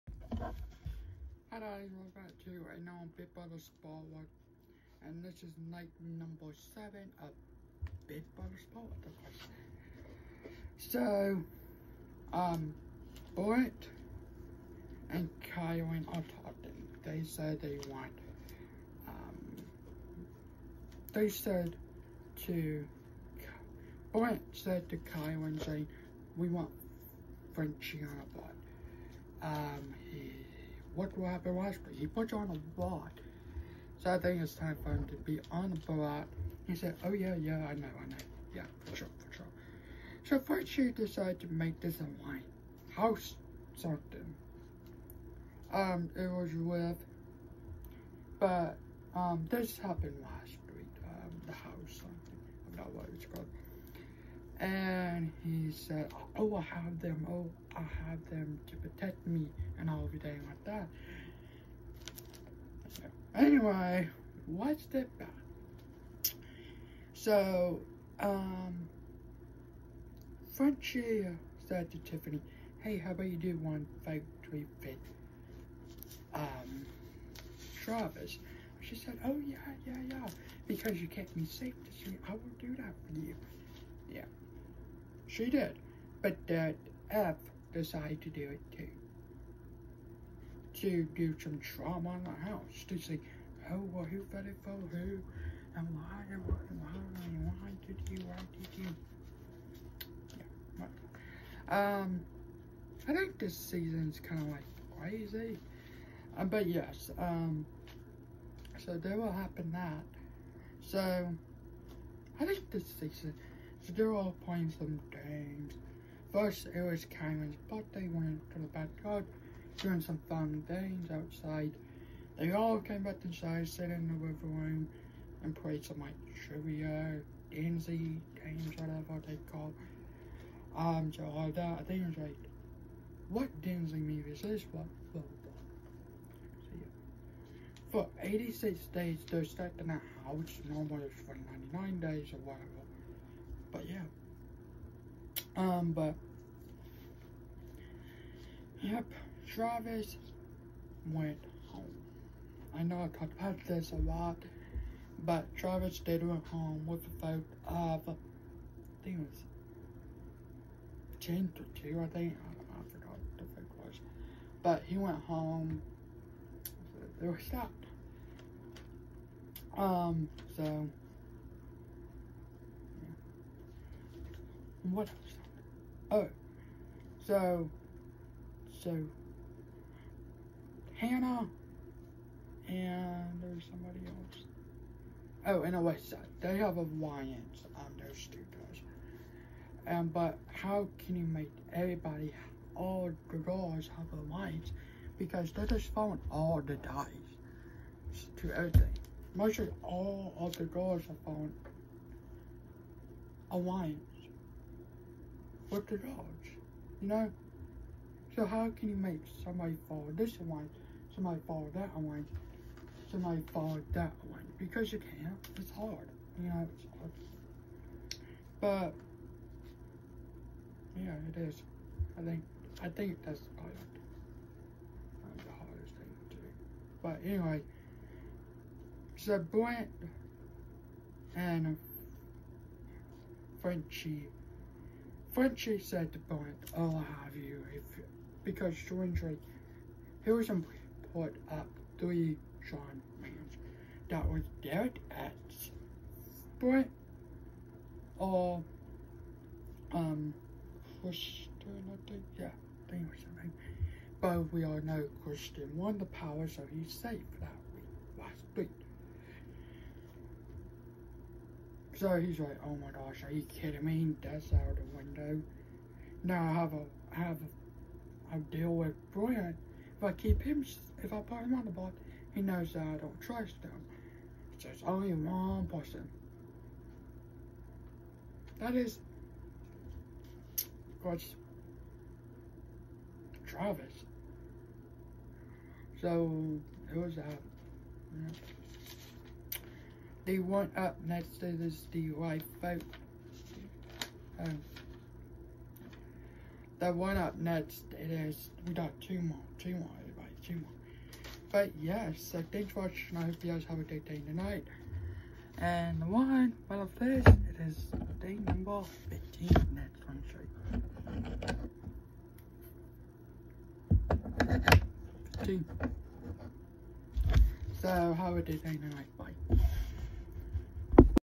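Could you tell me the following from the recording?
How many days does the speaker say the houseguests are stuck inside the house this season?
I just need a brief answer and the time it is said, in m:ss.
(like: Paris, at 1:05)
86, at 2:18.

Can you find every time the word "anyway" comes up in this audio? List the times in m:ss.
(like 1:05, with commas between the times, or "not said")
1:03, 3:47.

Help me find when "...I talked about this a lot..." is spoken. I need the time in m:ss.
2:33.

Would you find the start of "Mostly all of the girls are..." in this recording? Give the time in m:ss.
3:19.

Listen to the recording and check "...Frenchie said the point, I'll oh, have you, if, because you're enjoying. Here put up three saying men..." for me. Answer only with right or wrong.
wrong.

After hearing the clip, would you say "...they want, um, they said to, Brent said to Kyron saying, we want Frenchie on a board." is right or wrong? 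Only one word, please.
right.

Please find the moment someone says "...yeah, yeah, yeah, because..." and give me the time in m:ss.
1:19.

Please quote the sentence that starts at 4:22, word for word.
So he's like, oh my gosh, are you kidding me?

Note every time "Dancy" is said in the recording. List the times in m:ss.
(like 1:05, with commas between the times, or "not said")
2:07, 2:13.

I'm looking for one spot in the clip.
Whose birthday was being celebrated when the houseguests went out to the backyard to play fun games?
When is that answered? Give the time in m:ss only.
1:57.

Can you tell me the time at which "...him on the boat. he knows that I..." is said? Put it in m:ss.
4:31.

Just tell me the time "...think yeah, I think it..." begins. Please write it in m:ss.
4:12.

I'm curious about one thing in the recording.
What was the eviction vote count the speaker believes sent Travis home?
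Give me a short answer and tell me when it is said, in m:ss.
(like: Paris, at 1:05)
10 to 2, at 2:41.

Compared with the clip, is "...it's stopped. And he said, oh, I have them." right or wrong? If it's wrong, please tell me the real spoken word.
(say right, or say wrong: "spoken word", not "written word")
wrong: "called", not "stopped".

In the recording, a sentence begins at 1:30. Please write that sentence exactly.
To do some drama in the house.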